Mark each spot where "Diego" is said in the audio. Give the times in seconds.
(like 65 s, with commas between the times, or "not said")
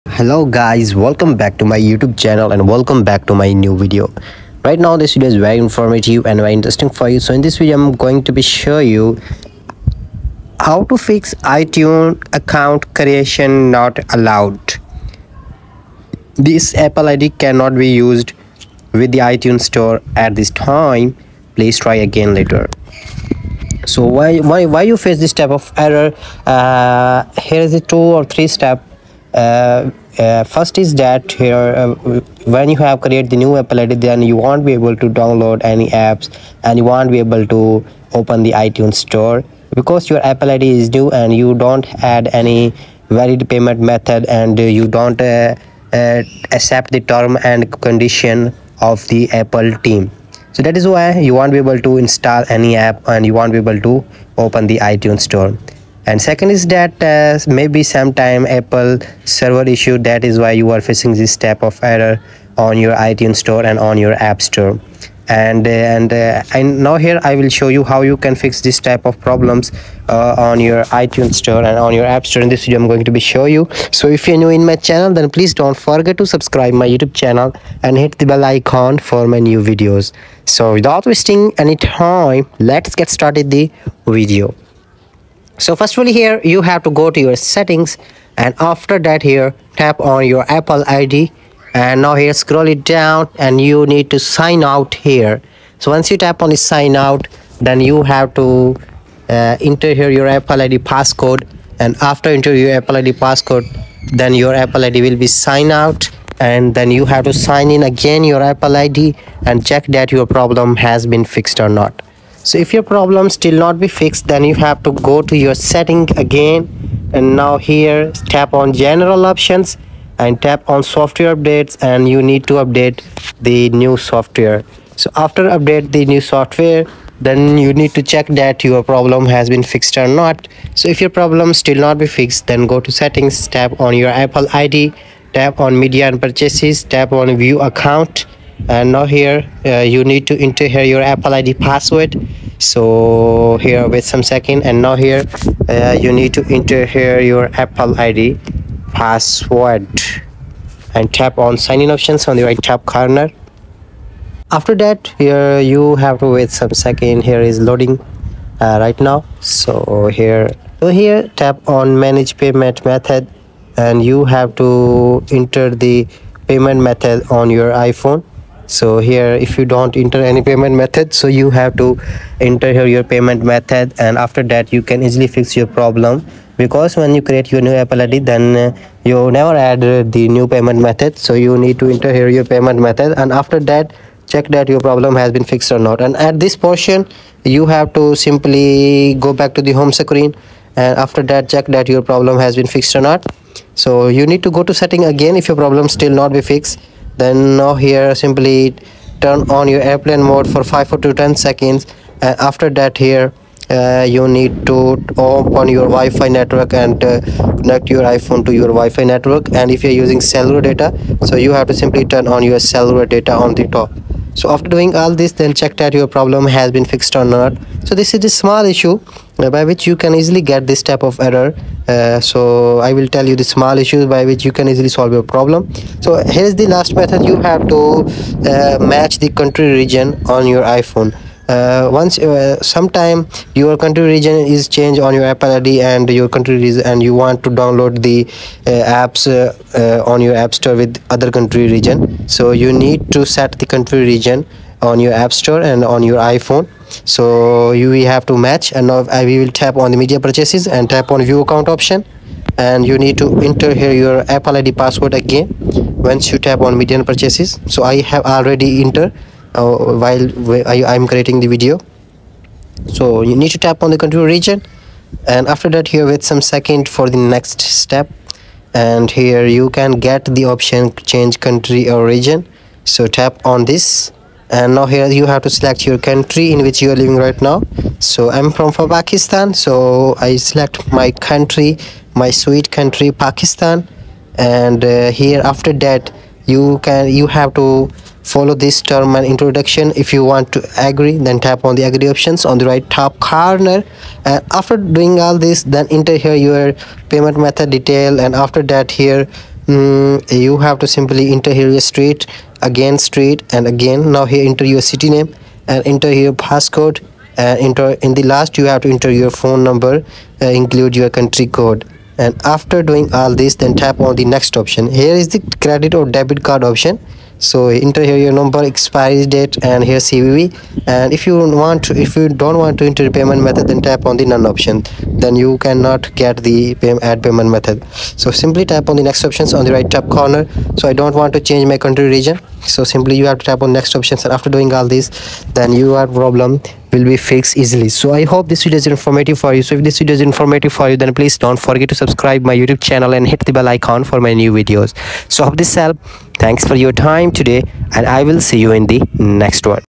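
not said.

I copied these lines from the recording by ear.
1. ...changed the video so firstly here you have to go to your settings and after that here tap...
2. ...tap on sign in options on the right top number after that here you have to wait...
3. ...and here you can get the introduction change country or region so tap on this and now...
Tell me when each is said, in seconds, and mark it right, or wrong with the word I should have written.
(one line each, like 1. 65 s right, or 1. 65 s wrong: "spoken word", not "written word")
1. 83 s wrong: "started", not "changed"
2. 151 s wrong: "corner", not "number"
3. 268 s wrong: "option", not "introduction".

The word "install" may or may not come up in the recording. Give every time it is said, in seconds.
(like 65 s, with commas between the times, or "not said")
51 s.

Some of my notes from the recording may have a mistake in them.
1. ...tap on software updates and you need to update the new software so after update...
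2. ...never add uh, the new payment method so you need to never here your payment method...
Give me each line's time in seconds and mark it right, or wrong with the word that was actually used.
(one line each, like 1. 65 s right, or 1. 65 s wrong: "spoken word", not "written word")
1. 120 s right
2. 179 s wrong: "enter", not "never".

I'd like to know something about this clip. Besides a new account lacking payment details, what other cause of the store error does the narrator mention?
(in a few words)
Apple server issue.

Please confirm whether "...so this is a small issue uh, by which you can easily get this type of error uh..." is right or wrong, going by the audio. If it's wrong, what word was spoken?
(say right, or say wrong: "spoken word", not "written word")
right.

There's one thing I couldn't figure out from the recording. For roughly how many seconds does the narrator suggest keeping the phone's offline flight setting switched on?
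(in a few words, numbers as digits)
5 to 10 seconds.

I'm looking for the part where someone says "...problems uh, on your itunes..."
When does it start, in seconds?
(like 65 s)
69 s.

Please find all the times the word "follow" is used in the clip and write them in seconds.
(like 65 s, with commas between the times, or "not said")
288 s.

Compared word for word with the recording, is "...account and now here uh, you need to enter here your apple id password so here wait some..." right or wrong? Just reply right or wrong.
right.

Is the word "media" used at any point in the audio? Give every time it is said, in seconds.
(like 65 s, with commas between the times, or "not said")
135 s, 250 s, 256 s.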